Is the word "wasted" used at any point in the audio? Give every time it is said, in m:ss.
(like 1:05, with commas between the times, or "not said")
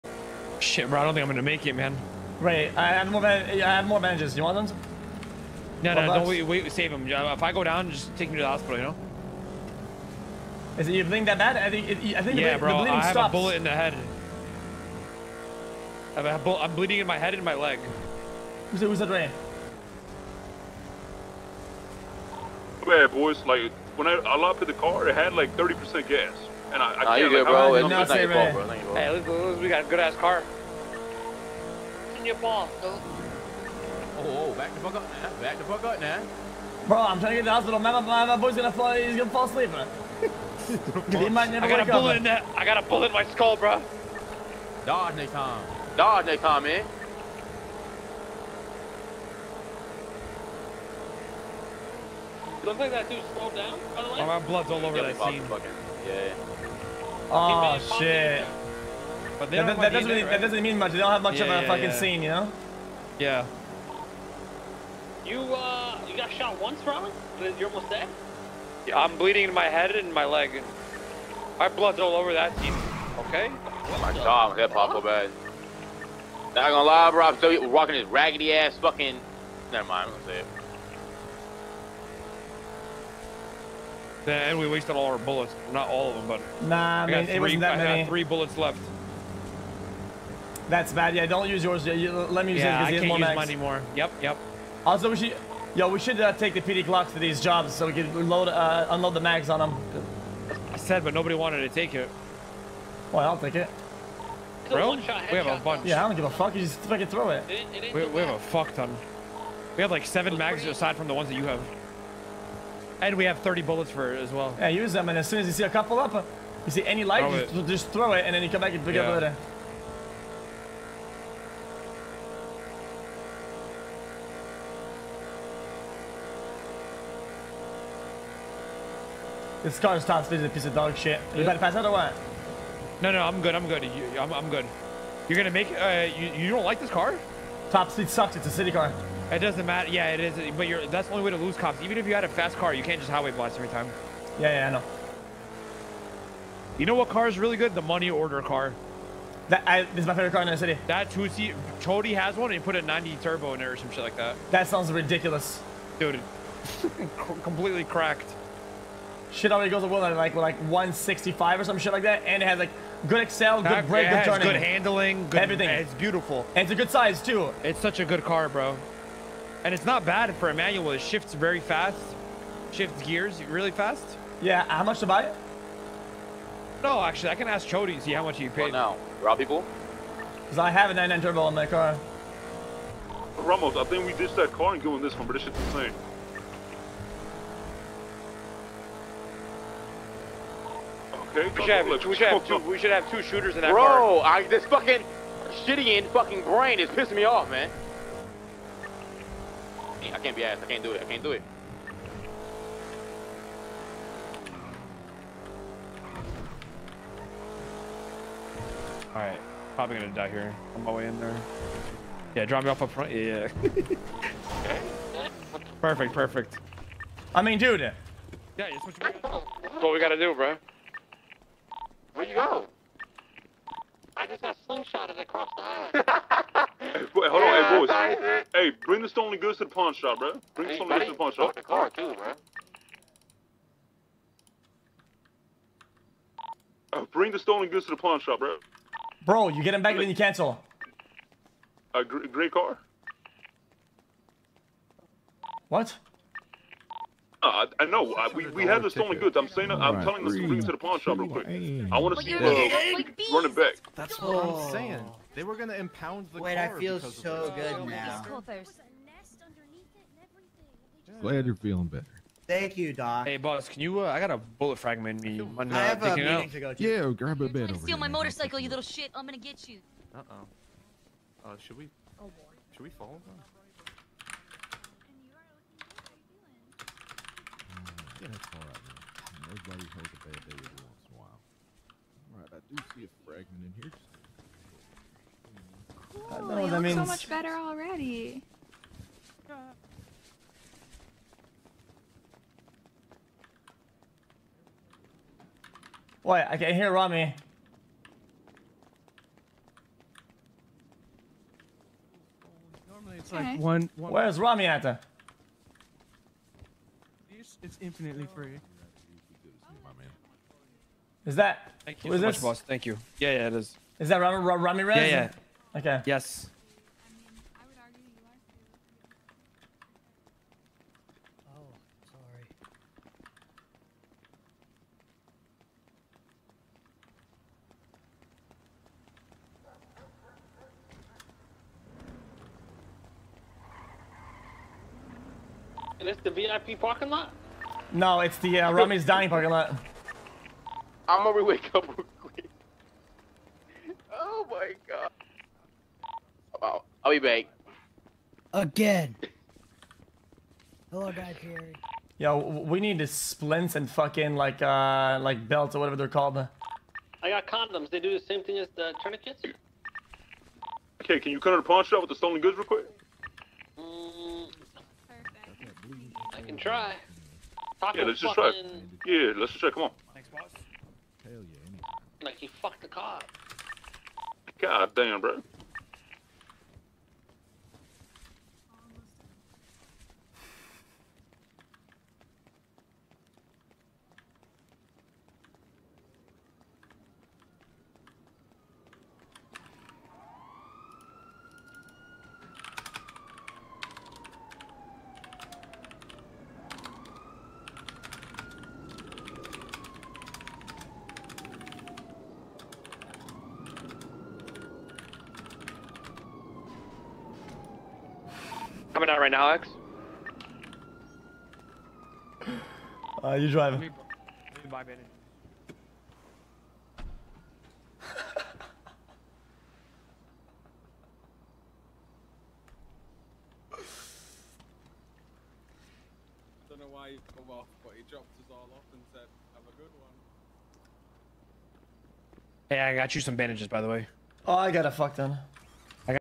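1:24.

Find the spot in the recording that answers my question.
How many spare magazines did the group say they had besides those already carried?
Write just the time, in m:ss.
1:50.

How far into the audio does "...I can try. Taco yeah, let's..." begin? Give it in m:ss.
6:06.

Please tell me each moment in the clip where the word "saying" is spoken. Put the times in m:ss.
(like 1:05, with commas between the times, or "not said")
4:09, 4:14.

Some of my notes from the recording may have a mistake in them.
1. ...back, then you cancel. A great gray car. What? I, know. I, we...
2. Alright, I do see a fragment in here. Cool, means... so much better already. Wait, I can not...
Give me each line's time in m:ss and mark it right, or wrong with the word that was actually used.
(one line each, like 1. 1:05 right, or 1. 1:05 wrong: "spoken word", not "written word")
1. 3:59 right
2. 4:42 right.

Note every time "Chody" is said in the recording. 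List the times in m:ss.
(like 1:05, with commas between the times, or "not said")
2:31, 2:57.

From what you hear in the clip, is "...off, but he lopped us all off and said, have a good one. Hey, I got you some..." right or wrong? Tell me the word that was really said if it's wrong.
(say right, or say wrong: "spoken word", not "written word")
wrong: "dropped", not "lopped".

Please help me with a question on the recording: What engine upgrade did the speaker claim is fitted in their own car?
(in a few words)
99 turbo.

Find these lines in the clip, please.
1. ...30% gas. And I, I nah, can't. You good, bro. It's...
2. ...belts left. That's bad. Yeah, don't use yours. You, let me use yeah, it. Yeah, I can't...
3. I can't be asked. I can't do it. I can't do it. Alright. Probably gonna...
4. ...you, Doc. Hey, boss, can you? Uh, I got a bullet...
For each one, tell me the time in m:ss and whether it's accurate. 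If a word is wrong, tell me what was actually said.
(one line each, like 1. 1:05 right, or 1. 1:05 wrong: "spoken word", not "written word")
1. 0:25 right
2. 1:28 wrong: "bullets", not "belts"
3. 3:20 right
4. 4:22 right.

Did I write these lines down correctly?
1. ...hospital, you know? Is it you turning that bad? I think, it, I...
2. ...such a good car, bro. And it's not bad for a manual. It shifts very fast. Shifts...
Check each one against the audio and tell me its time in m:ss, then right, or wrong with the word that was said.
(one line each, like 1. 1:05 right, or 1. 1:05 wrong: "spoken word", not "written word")
1. 0:08 wrong: "bleeding", not "turning"
2. 2:47 right.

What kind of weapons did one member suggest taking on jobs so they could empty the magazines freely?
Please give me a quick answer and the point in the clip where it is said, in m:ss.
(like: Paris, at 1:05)
PD Glocks, at 1:36.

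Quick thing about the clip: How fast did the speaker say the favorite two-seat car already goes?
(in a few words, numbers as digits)
165.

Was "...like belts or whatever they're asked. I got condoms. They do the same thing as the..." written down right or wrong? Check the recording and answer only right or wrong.
wrong.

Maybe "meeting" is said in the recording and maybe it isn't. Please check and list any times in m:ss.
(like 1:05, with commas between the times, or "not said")
4:26.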